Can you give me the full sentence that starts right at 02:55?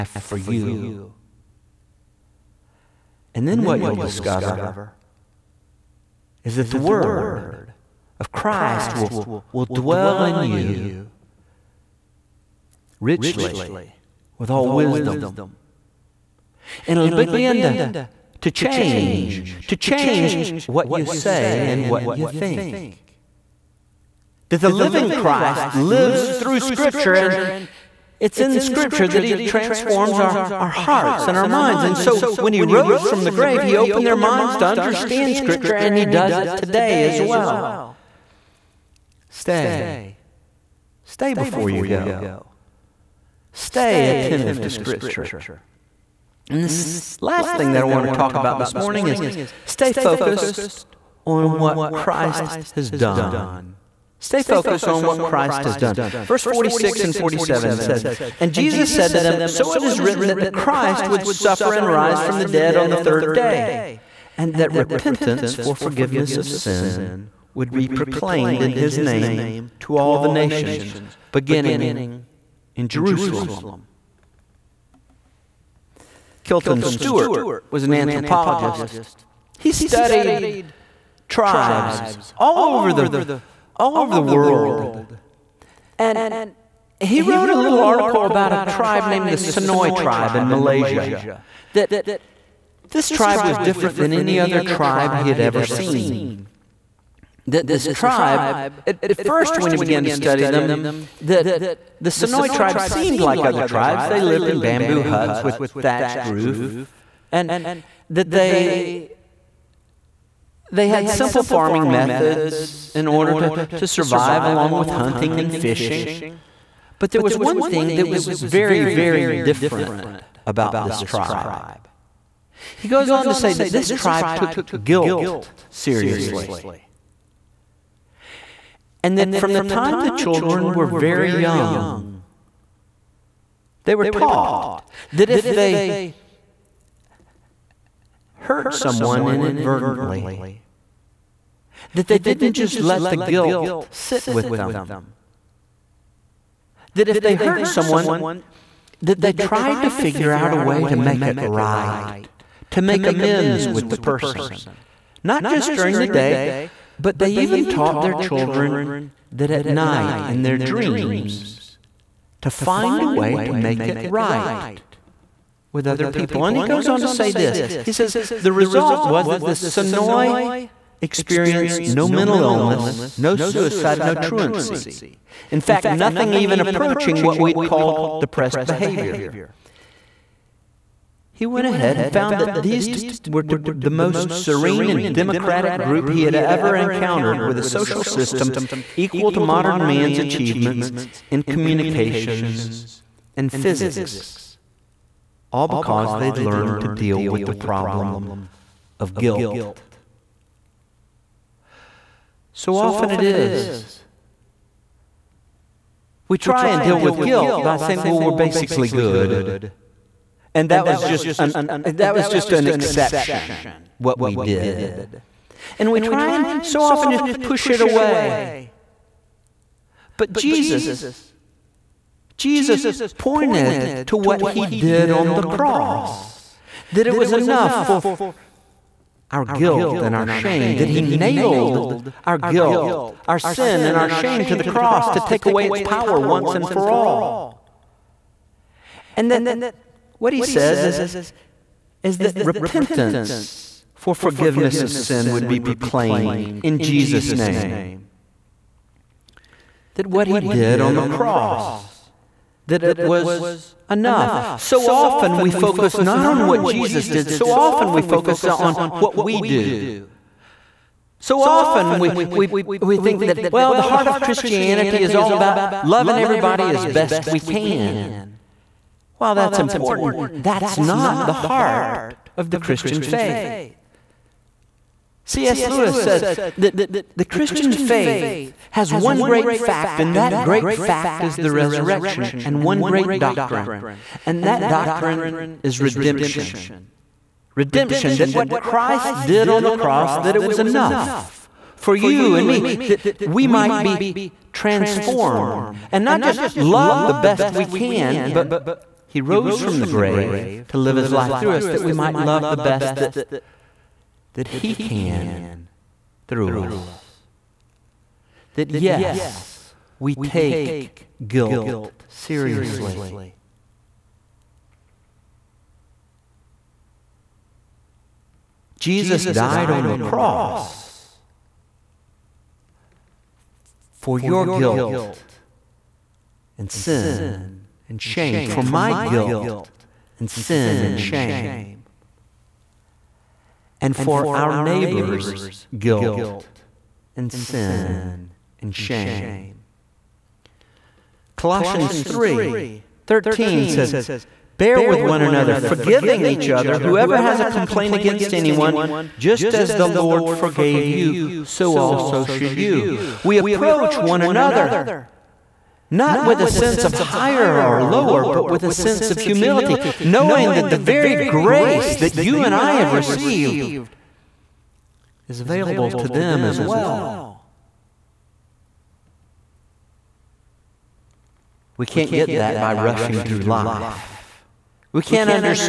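In fact, nothing even approaching what we'd called depressed behavior.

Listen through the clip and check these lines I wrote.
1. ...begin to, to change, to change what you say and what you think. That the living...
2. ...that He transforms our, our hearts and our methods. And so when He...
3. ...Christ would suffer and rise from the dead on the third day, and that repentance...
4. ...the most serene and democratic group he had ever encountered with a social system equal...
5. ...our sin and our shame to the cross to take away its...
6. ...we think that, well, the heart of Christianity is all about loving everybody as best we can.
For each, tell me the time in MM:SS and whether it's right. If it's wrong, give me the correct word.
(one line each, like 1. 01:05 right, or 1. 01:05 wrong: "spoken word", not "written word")
1. 00:17 right
2. 00:29 wrong: "minds", not "methods"
3. 01:00 right
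4. 03:03 right
5. 03:53 right
6. 04:22 right.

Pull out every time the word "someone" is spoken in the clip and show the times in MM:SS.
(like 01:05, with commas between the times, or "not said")
02:18, 02:27.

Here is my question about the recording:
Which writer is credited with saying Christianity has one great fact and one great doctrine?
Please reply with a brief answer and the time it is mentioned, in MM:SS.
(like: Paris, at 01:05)
C.S. Lewis, at 04:35.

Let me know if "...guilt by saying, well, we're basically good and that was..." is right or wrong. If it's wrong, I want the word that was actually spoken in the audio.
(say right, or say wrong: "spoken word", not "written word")
right.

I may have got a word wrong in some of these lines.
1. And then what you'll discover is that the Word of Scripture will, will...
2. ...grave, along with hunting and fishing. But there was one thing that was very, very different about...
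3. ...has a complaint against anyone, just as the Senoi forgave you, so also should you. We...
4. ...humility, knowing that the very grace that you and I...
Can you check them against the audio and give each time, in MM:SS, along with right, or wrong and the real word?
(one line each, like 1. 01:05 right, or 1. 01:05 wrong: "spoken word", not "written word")
1. 00:03 wrong: "Christ", not "Scripture"
2. 01:53 wrong: "survive", not "grave"
3. 05:47 wrong: "Lord", not "Senoi"
4. 05:59 right.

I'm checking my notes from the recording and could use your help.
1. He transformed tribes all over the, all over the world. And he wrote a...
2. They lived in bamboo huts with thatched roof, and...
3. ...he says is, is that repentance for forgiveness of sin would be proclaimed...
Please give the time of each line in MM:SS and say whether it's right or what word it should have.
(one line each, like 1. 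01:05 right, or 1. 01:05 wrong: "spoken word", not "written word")
1. 01:19 wrong: "studied", not "transformed"
2. 01:44 right
3. 04:00 right.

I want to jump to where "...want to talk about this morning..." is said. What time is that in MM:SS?
00:47.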